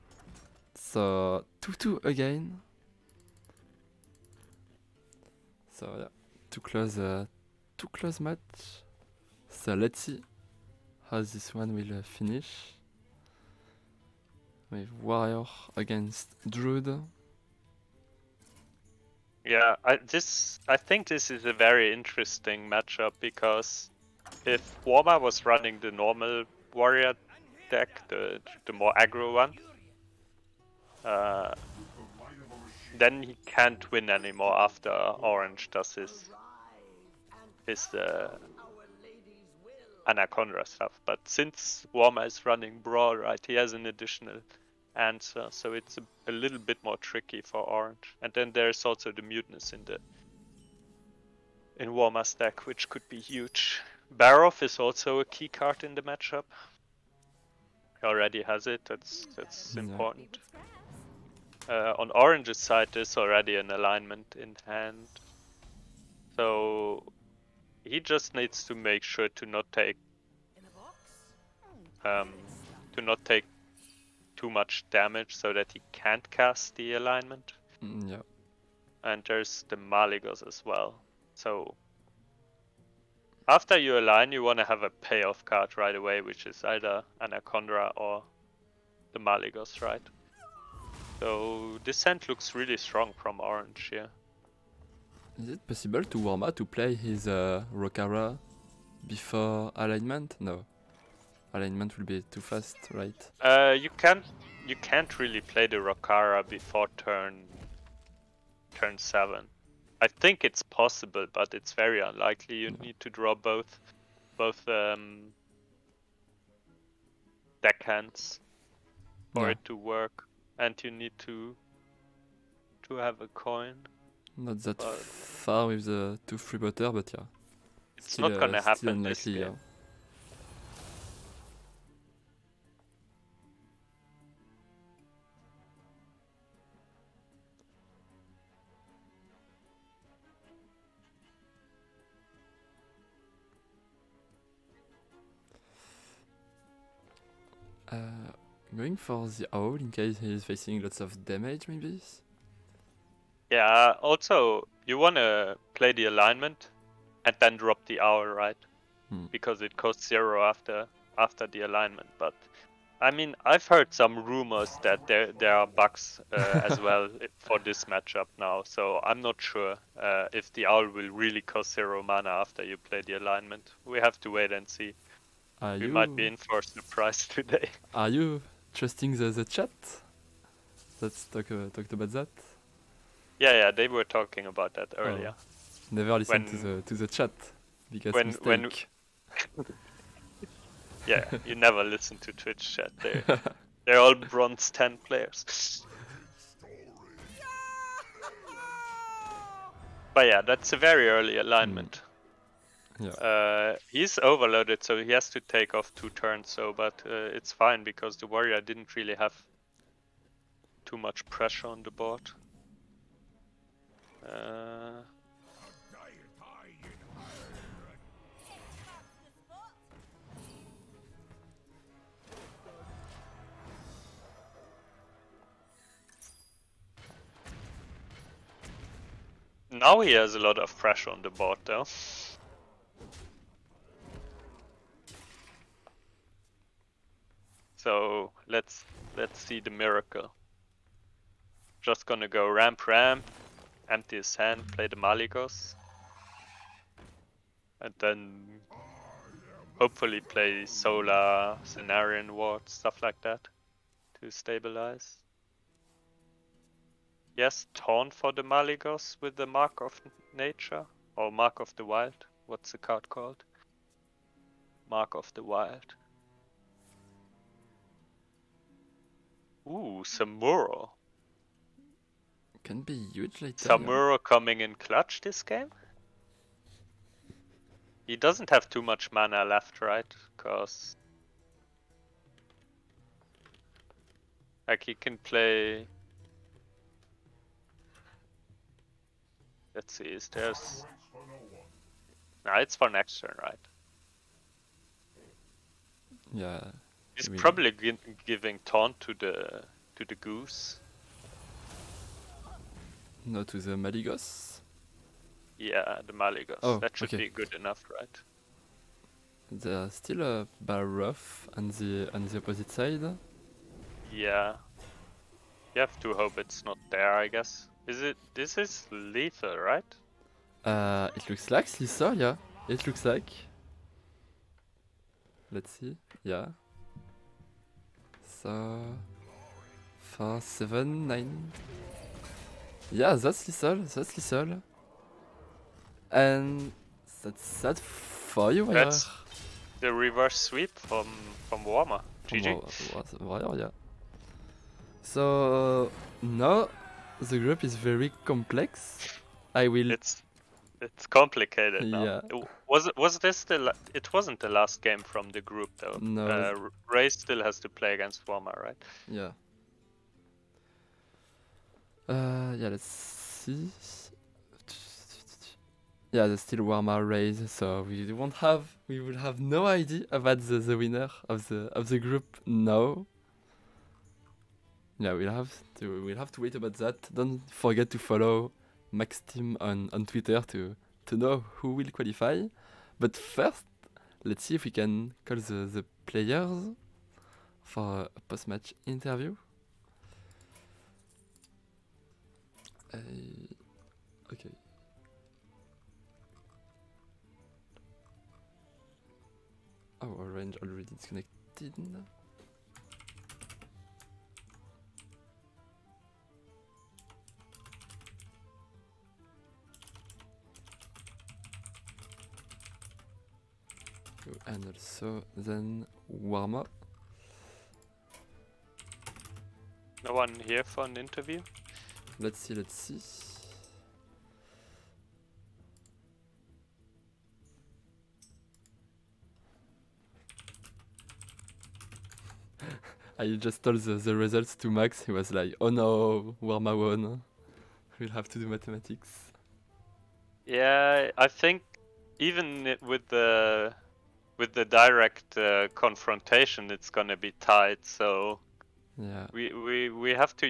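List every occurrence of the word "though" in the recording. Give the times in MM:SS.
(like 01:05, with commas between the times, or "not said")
03:51, 05:55.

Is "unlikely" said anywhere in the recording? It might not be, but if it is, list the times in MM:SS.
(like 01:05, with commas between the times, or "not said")
01:51, 02:08.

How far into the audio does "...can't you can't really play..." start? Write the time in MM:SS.
01:43.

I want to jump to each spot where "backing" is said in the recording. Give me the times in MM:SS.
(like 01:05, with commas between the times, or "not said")
not said.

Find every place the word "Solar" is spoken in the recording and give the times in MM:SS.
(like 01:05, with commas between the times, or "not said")
04:10.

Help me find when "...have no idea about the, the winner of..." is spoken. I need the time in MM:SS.
06:09.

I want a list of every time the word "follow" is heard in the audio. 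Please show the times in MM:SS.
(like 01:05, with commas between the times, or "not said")
06:17.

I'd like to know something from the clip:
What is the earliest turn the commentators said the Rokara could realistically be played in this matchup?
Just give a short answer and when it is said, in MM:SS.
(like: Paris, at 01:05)
Turn 7, at 01:48.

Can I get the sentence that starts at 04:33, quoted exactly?
Samuro coming in clutch this game?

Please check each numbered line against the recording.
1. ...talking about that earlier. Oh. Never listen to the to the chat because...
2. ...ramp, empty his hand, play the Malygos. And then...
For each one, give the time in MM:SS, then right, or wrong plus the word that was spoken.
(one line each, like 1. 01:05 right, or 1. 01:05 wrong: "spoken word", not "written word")
1. 03:04 right
2. 04:02 right.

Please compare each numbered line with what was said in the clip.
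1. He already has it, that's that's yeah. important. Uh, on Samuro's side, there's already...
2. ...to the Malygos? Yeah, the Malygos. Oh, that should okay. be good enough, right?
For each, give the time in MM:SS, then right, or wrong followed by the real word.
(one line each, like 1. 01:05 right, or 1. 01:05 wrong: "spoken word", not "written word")
1. 00:57 wrong: "Orange", not "Samuro"
2. 05:03 right.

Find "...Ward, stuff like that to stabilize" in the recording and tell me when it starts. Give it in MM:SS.
04:12.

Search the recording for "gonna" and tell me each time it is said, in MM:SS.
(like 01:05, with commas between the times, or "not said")
02:08, 04:02, 07:26.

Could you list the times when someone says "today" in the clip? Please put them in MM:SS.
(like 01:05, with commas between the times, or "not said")
02:57.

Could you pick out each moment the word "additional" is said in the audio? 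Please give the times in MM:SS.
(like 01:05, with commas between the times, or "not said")
00:43.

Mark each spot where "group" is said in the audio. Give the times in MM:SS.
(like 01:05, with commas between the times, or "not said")
05:47, 05:55, 06:11.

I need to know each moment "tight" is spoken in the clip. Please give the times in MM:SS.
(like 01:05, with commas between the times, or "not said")
07:27.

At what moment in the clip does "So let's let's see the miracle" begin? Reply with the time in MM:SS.
03:57.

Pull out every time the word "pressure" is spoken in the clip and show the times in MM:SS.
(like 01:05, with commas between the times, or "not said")
03:31, 03:50.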